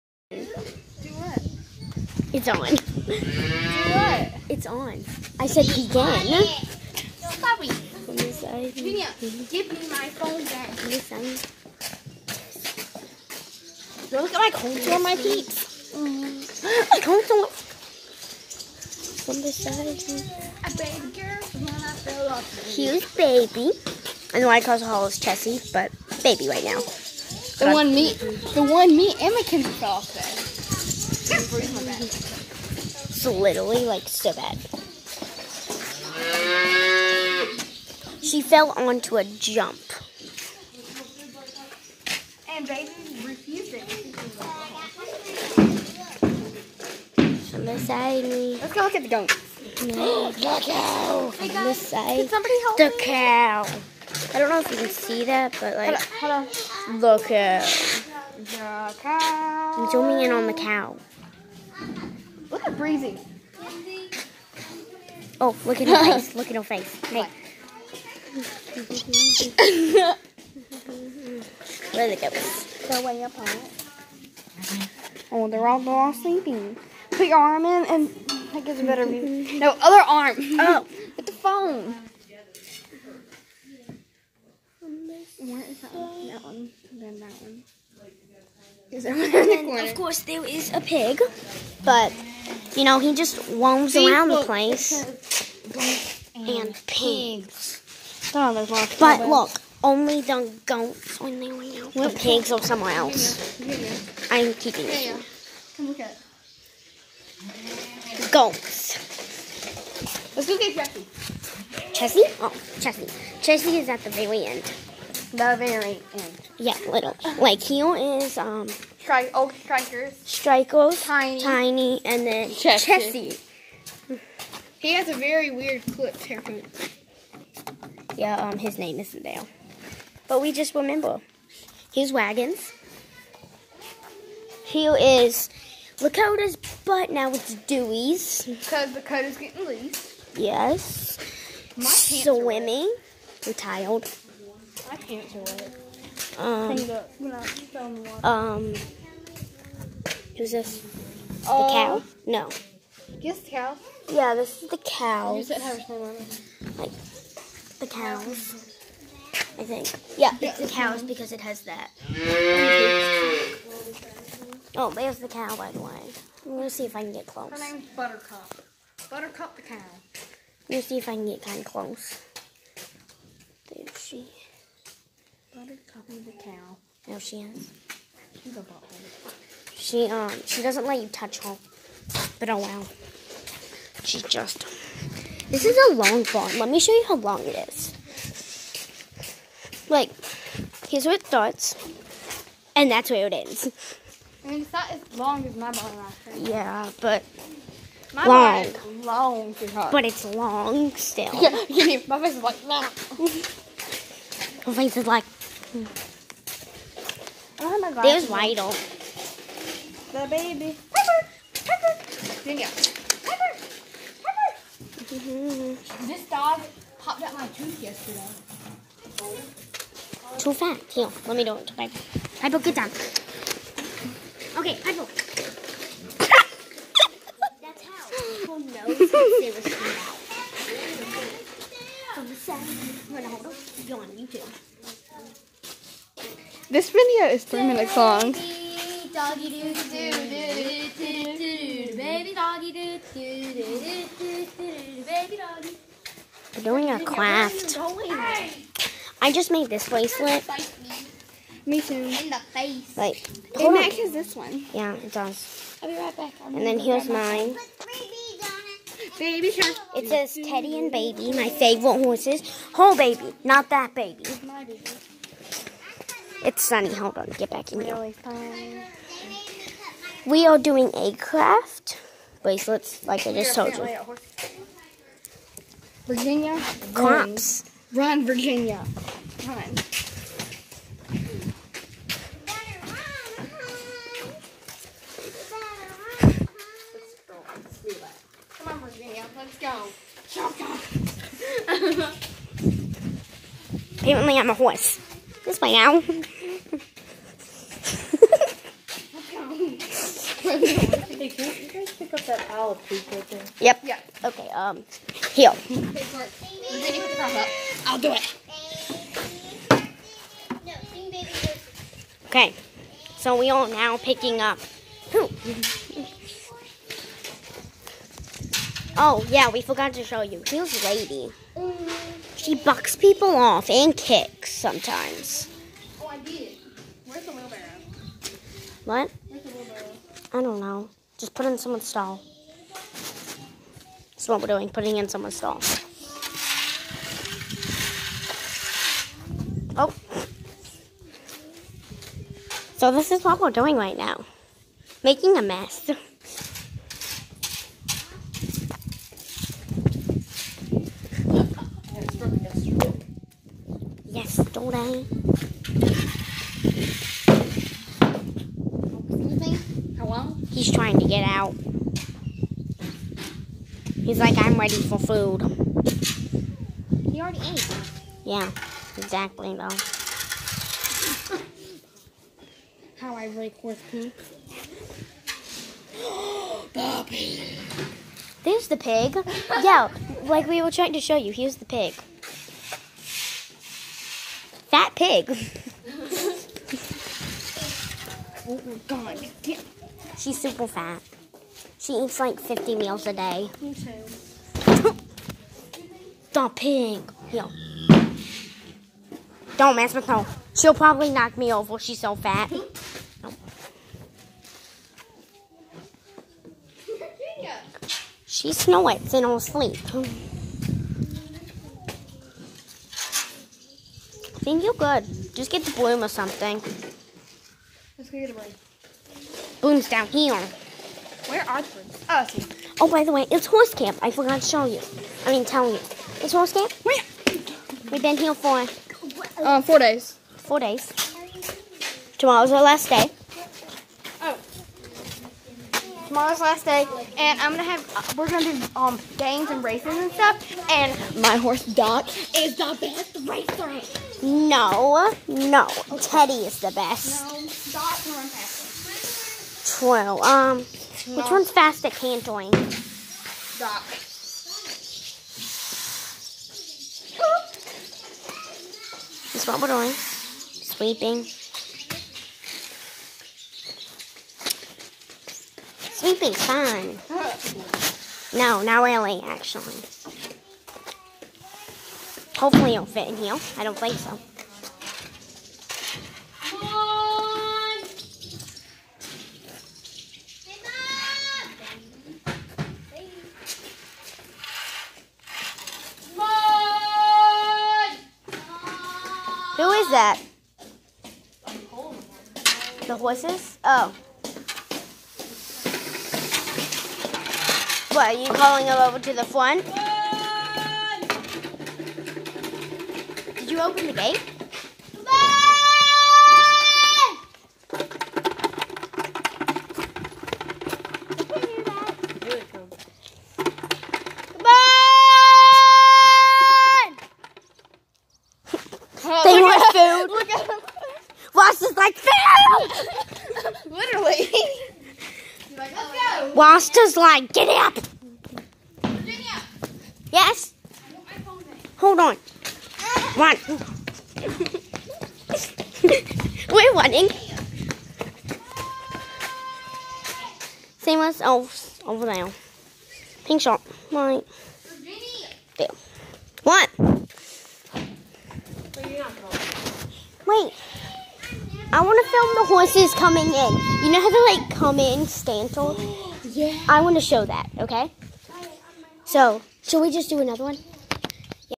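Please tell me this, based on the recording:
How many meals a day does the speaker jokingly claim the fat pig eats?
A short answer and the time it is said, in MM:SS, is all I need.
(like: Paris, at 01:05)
50, at 06:32.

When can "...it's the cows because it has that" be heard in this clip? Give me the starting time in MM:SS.
02:40.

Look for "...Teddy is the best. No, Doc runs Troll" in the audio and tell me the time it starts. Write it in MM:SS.
07:25.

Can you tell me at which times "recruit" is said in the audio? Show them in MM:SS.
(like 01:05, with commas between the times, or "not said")
not said.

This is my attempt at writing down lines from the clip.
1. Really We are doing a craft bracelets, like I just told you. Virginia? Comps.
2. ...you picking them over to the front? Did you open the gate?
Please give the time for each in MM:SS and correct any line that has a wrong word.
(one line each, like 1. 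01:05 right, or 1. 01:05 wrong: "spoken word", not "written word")
1. 04:27 right
2. 08:18 wrong: "calling", not "picking".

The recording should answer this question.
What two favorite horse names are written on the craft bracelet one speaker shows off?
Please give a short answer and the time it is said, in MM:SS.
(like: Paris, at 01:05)
Teddy and Baby, at 04:20.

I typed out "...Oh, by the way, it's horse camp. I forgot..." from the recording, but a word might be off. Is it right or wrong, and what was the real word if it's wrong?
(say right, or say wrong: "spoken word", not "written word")
right.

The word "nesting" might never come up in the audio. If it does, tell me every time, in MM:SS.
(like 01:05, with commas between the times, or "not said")
not said.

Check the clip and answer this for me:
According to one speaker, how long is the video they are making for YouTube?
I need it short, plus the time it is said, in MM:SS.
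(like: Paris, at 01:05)
3 minutes, at 03:57.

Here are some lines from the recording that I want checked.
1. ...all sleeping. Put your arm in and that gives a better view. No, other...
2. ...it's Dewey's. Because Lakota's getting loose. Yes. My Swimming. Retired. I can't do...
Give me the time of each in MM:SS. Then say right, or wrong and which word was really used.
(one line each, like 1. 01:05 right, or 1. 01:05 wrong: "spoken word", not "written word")
1. 01:15 right
2. 02:17 right.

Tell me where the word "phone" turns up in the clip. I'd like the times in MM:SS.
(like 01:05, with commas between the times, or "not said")
00:10, 01:21.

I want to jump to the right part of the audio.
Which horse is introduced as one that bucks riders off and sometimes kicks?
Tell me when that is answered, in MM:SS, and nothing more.
05:20.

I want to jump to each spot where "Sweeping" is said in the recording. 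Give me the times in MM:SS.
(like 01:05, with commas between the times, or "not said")
07:39, 07:45.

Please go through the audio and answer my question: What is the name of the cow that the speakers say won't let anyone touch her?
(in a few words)
Buttercup.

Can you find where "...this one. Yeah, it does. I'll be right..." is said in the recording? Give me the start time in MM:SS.
04:14.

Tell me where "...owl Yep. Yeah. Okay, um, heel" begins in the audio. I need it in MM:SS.
05:02.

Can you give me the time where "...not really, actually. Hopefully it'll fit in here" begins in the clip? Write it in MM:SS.
07:48.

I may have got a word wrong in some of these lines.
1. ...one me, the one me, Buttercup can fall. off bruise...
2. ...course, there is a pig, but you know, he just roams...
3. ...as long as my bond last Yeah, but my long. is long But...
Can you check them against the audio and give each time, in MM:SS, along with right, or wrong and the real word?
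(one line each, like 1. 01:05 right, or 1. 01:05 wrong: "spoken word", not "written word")
1. 00:27 wrong: "Emma", not "Buttercup"
2. 01:29 right
3. 03:14 right.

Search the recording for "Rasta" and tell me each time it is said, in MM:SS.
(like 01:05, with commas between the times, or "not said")
08:46.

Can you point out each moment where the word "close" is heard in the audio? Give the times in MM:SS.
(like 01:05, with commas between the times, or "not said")
02:47, 02:51.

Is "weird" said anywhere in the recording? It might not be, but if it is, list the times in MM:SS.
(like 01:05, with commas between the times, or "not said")
02:05.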